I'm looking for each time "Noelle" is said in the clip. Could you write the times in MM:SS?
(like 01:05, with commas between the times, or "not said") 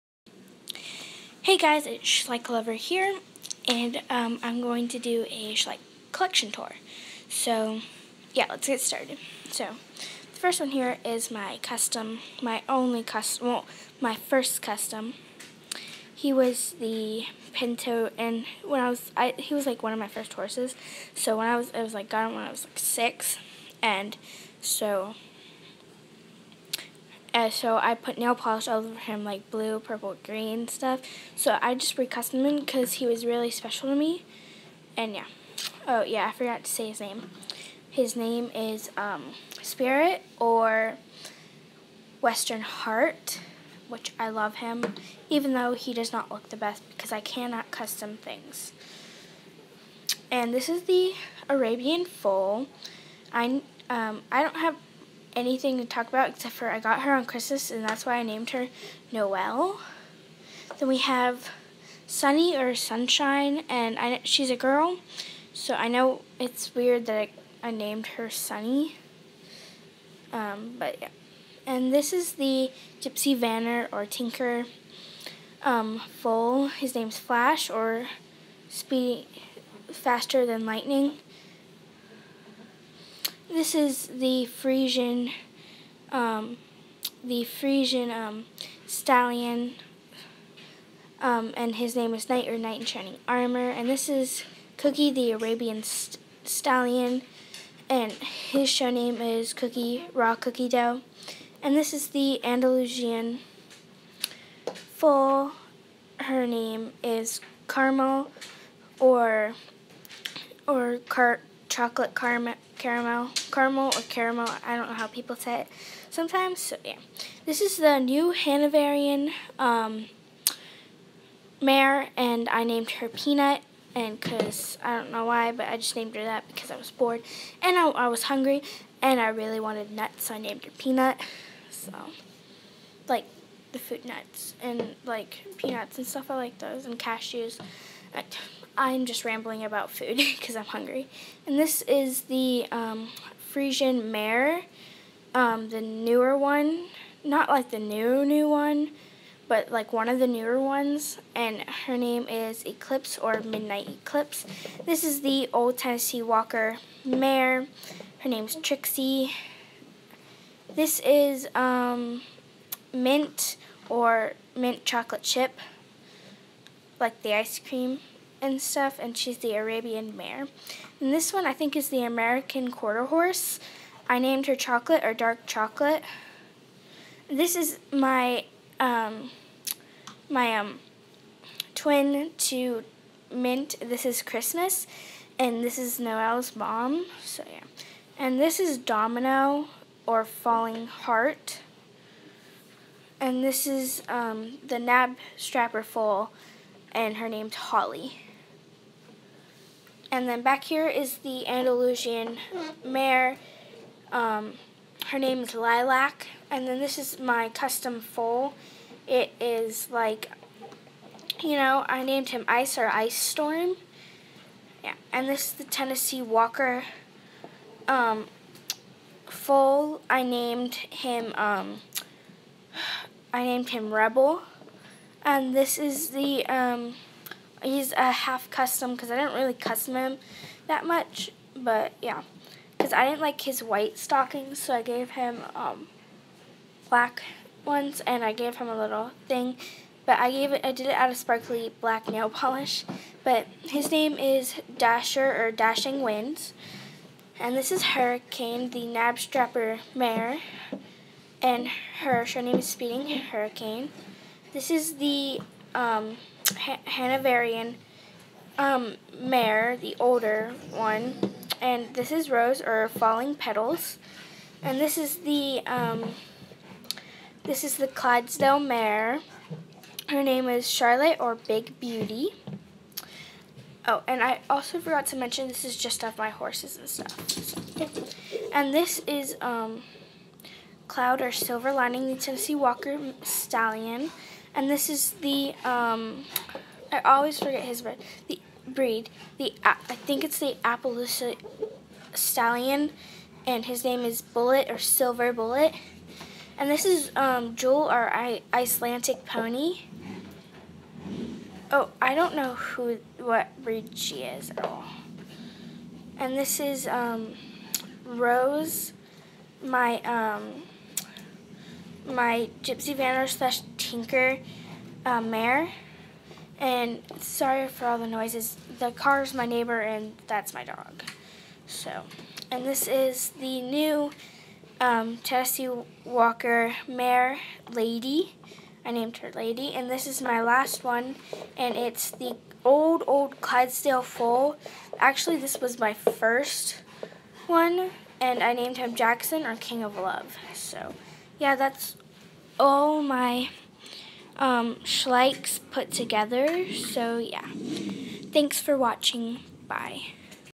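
00:59, 03:05.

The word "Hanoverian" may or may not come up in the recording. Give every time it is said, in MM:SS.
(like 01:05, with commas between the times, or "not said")
01:58, 04:16.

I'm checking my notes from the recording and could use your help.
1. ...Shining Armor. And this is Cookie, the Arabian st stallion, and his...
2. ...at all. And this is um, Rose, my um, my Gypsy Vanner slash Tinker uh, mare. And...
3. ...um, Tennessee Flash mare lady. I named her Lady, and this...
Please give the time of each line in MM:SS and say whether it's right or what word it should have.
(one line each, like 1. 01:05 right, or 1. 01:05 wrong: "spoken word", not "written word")
1. 01:32 right
2. 05:04 right
3. 05:24 wrong: "Walker", not "Flash".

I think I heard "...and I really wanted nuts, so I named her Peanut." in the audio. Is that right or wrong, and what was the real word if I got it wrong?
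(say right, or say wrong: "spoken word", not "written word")
right.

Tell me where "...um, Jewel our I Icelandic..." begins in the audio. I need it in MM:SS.
04:57.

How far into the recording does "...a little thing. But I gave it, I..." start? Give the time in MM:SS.
03:58.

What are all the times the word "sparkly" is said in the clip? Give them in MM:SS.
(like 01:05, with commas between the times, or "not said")
04:01.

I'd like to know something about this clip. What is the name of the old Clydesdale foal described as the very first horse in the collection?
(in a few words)
Jackson.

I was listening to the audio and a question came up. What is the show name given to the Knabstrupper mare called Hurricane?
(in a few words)
Speeding Hurricane.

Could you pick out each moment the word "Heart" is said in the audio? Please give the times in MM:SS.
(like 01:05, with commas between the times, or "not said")
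00:42, 03:10.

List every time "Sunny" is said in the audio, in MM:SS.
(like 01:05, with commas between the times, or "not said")
01:02, 01:08.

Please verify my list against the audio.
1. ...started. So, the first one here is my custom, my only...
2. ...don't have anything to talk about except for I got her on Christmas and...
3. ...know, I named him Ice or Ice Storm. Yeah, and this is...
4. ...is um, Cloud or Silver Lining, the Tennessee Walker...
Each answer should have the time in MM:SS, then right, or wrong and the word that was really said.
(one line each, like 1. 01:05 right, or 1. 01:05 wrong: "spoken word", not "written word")
1. 00:08 right
2. 00:54 right
3. 03:31 right
4. 04:39 right.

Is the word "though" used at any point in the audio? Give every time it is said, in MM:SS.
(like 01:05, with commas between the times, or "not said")
00:45.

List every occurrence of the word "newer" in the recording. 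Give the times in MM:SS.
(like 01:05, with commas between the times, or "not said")
02:25, 02:30.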